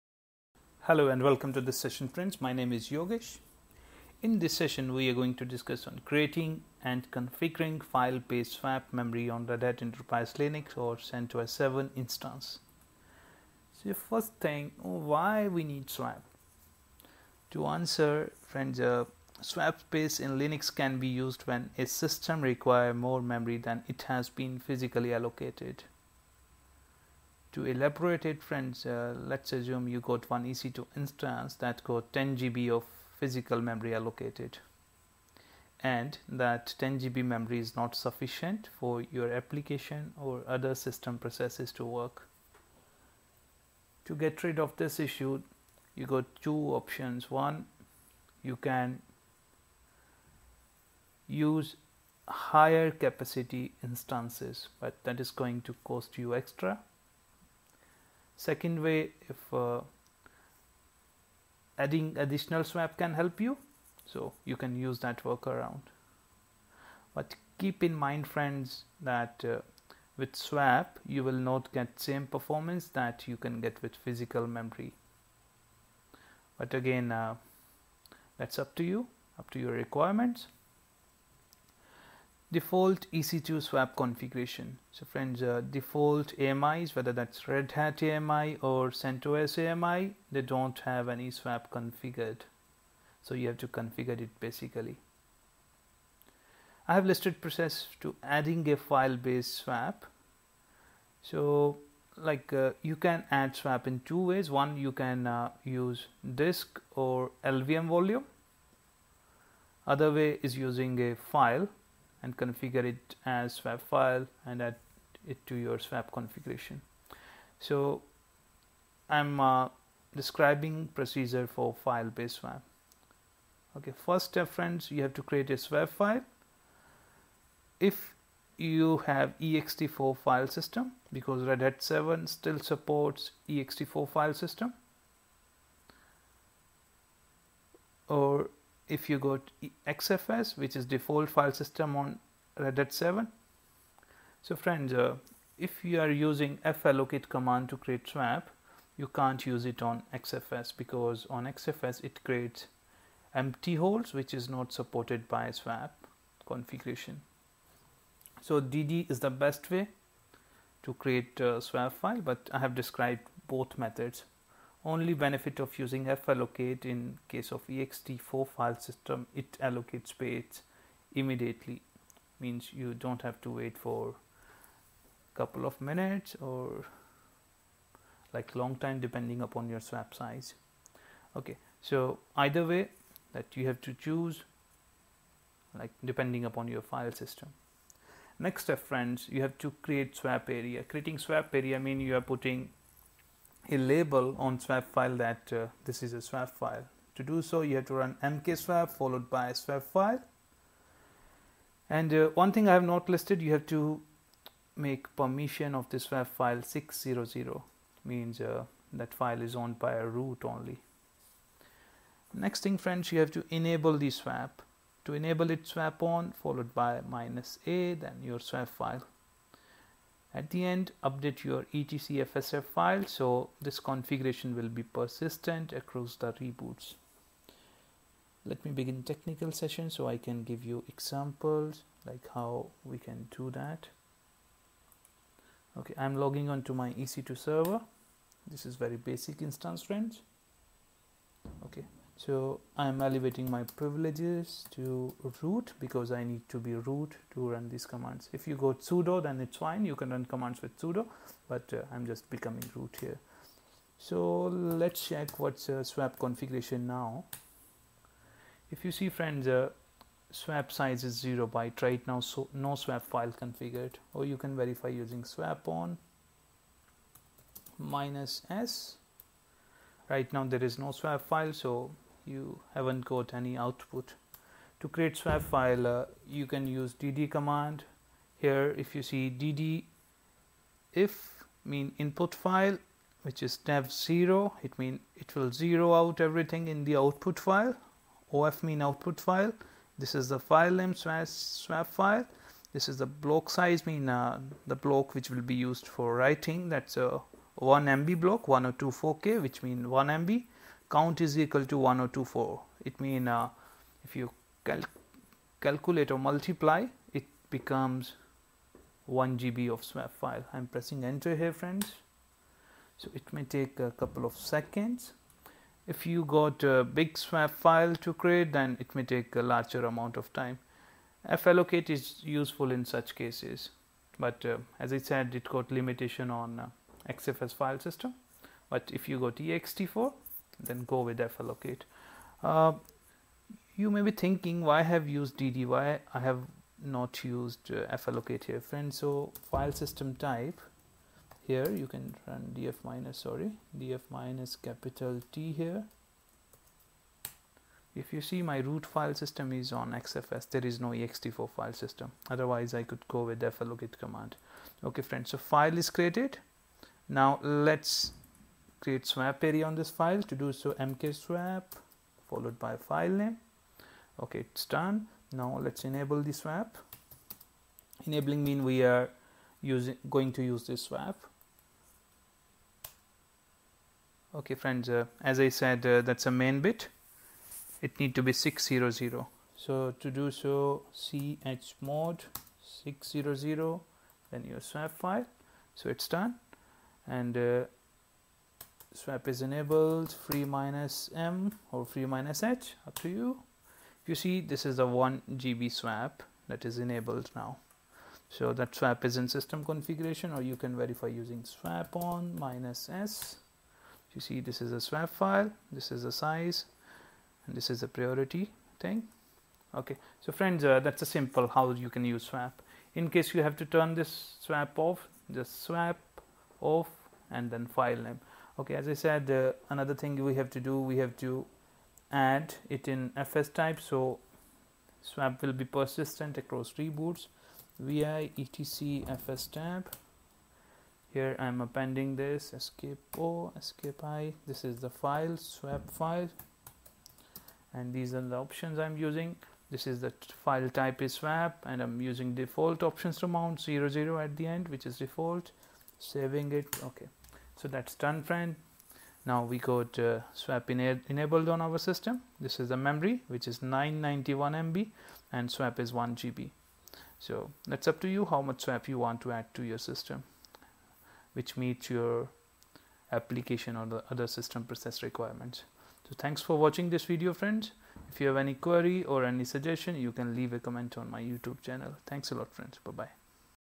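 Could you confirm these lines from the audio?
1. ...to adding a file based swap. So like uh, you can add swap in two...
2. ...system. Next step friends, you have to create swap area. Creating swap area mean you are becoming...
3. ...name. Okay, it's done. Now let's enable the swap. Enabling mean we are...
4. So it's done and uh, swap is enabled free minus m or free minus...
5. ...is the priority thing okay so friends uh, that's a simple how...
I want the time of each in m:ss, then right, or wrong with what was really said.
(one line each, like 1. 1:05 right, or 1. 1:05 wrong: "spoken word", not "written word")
1. 1:38 right
2. 3:07 wrong: "putting", not "becoming"
3. 6:03 right
4. 6:25 right
5. 6:47 right.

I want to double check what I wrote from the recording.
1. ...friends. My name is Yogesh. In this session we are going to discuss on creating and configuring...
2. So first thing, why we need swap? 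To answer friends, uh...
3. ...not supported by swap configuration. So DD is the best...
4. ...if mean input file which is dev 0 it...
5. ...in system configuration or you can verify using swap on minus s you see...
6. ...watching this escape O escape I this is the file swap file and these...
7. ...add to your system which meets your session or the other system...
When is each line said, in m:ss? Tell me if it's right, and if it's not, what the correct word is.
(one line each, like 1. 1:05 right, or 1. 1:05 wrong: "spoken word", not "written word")
1. 0:02 right
2. 0:13 right
3. 2:34 right
4. 4:41 right
5. 6:39 right
6. 7:11 wrong: "appending", not "watching"
7. 7:39 wrong: "application", not "session".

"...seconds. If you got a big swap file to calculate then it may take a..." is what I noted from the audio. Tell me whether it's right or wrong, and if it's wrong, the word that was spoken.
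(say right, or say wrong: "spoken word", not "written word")
wrong: "create", not "calculate".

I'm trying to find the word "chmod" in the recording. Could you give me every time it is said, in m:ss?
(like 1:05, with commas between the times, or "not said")
6:20.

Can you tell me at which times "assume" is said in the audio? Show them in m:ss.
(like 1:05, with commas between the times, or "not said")
0:29.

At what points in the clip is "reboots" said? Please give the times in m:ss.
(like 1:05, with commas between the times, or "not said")
3:46, 7:06.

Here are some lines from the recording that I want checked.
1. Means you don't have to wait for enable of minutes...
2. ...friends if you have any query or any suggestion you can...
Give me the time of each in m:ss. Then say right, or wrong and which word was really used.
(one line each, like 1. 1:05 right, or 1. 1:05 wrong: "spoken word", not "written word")
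1. 2:52 wrong: "couple", not "enable"
2. 7:47 right.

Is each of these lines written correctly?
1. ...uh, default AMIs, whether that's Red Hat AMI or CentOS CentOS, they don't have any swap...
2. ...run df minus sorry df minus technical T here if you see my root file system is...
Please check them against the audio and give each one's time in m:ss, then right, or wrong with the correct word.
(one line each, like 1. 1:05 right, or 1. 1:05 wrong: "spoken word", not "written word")
1. 1:25 wrong: "AMI", not "CentOS"
2. 5:42 wrong: "capital", not "technical".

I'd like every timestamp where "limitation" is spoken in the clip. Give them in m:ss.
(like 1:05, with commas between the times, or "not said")
5:25.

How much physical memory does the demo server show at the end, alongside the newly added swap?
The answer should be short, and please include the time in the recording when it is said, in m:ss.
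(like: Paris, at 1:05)
991 MB, at 7:33.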